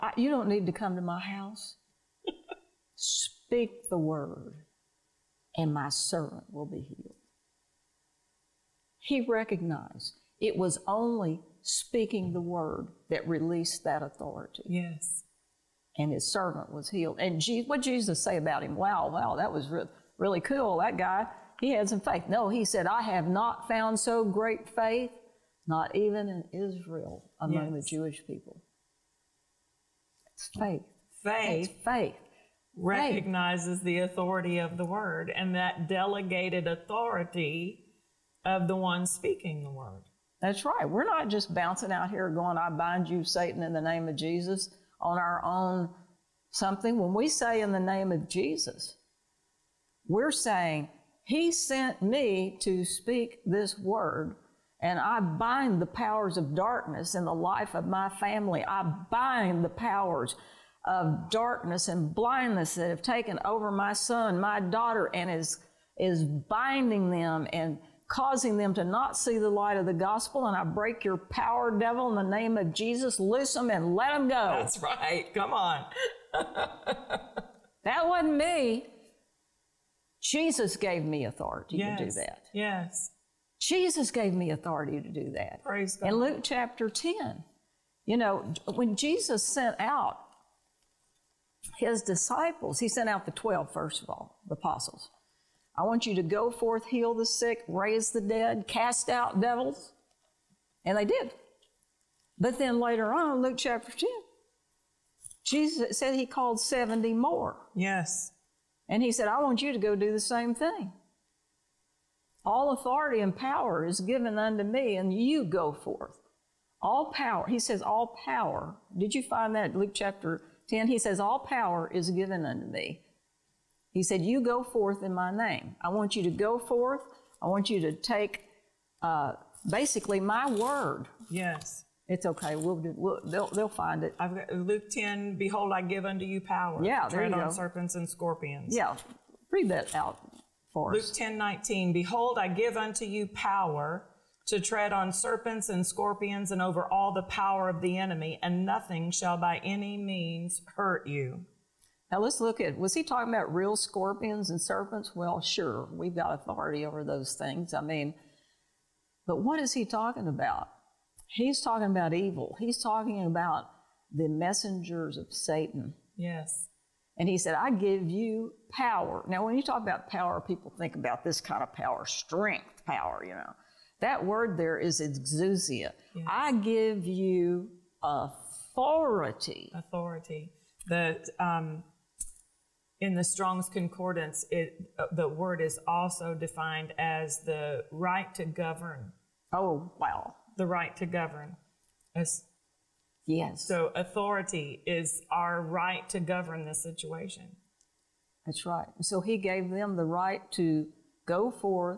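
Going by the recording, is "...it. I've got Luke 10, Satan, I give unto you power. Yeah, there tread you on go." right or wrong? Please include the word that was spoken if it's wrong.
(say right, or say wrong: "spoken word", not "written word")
wrong: "Behold", not "Satan".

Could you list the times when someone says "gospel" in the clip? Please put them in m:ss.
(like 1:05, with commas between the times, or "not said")
1:09.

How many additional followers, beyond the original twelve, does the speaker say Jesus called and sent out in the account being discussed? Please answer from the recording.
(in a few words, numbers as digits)
70.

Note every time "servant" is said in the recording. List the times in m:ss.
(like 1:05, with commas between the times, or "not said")
0:05, 0:16.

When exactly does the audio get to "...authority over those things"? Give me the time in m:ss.
2:36.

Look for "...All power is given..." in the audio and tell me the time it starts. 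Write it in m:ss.
2:01.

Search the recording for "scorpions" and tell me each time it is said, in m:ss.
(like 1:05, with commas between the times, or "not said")
2:18, 2:25, 2:33.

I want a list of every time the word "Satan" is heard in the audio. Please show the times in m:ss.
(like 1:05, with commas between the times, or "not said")
0:43, 2:45.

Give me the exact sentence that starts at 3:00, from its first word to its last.
The um, in the Strong's Concordance, it uh, the word is also defined as the right to govern.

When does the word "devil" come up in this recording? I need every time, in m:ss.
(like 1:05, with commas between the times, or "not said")
1:11, 1:39.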